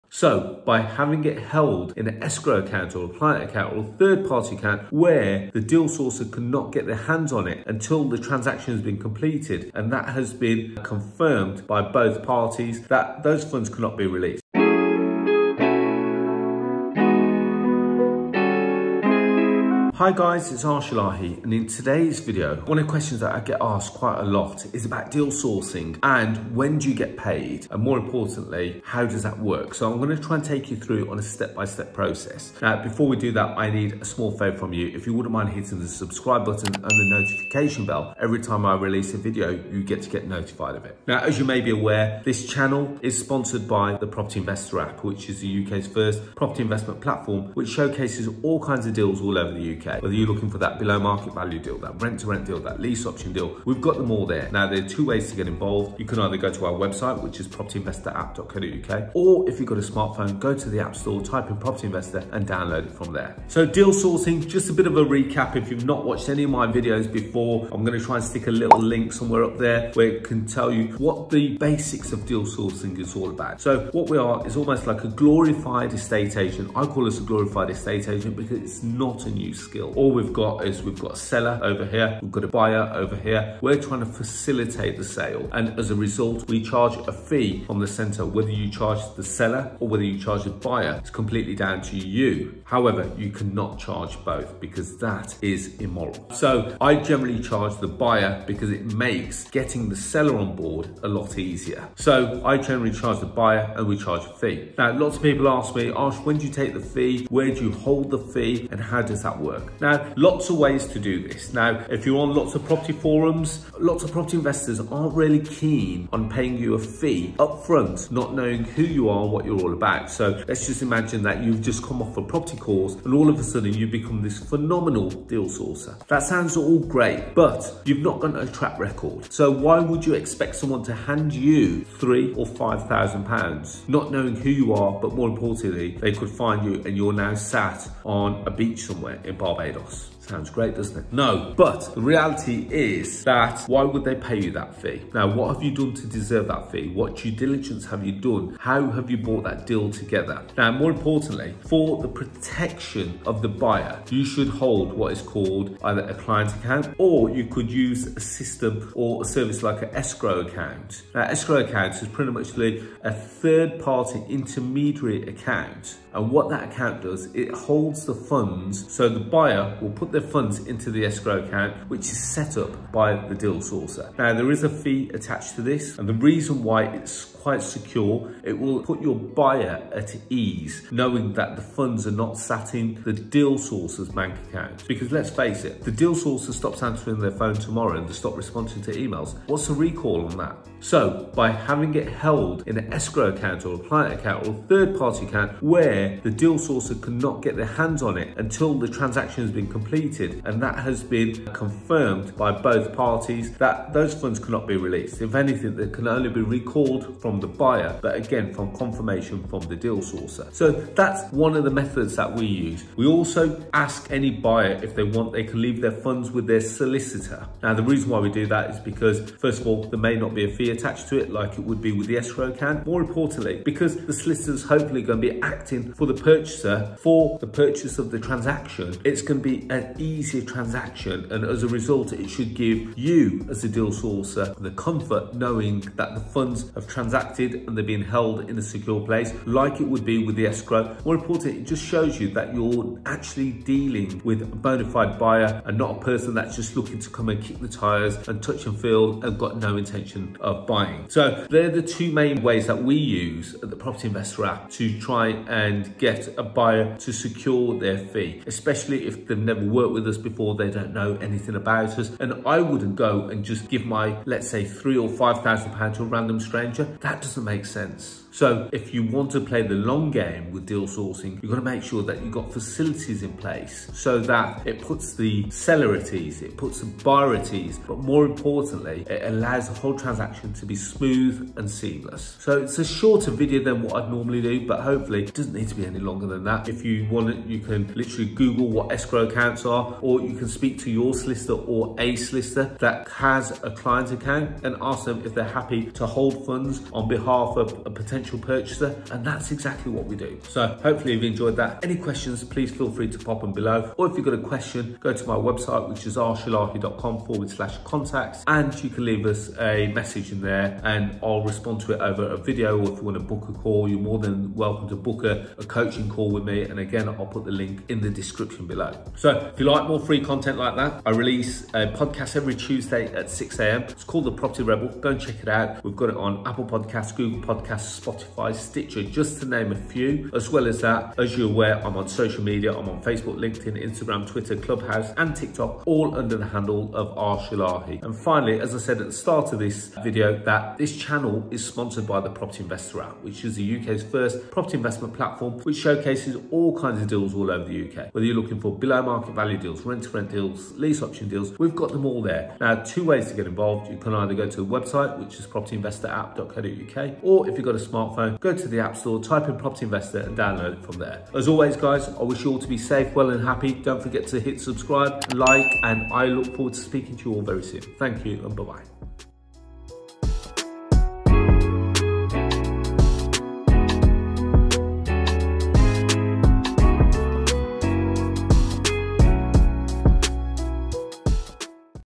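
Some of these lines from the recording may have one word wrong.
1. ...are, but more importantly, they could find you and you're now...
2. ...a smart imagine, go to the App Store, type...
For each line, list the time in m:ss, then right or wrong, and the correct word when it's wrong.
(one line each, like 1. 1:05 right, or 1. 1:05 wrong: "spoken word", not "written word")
1. 2:14 right
2. 5:57 wrong: "smartphone", not "imagine".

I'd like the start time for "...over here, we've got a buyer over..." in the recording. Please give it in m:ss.
1:21.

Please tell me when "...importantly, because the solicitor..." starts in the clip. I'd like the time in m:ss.
3:43.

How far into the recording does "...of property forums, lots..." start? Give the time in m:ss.
1:52.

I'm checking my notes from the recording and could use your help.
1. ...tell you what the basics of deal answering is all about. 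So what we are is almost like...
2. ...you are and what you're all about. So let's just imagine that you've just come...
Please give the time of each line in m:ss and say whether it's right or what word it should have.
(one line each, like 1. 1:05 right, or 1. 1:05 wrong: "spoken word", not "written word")
1. 1:10 wrong: "sourcing", not "answering"
2. 1:58 right.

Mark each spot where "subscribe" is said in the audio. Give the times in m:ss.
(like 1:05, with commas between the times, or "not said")
0:36, 6:04.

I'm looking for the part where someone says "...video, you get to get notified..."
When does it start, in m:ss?
0:39.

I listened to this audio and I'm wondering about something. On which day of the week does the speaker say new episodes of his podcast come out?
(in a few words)
Tuesday.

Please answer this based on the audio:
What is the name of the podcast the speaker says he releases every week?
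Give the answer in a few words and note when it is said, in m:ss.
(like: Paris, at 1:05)
The Property Rebel, at 5:24.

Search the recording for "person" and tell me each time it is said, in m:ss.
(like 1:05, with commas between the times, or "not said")
4:05.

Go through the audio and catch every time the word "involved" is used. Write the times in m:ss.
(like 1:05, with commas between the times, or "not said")
0:55, 5:53.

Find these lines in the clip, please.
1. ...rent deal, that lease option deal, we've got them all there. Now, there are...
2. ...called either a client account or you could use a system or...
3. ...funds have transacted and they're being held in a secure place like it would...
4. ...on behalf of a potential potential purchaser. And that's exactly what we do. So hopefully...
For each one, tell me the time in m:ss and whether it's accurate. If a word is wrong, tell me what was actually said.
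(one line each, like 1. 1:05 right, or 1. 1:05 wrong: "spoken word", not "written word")
1. 0:52 right
2. 2:35 right
3. 3:56 right
4. 4:56 right.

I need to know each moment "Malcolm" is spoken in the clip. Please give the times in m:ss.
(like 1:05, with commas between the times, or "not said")
not said.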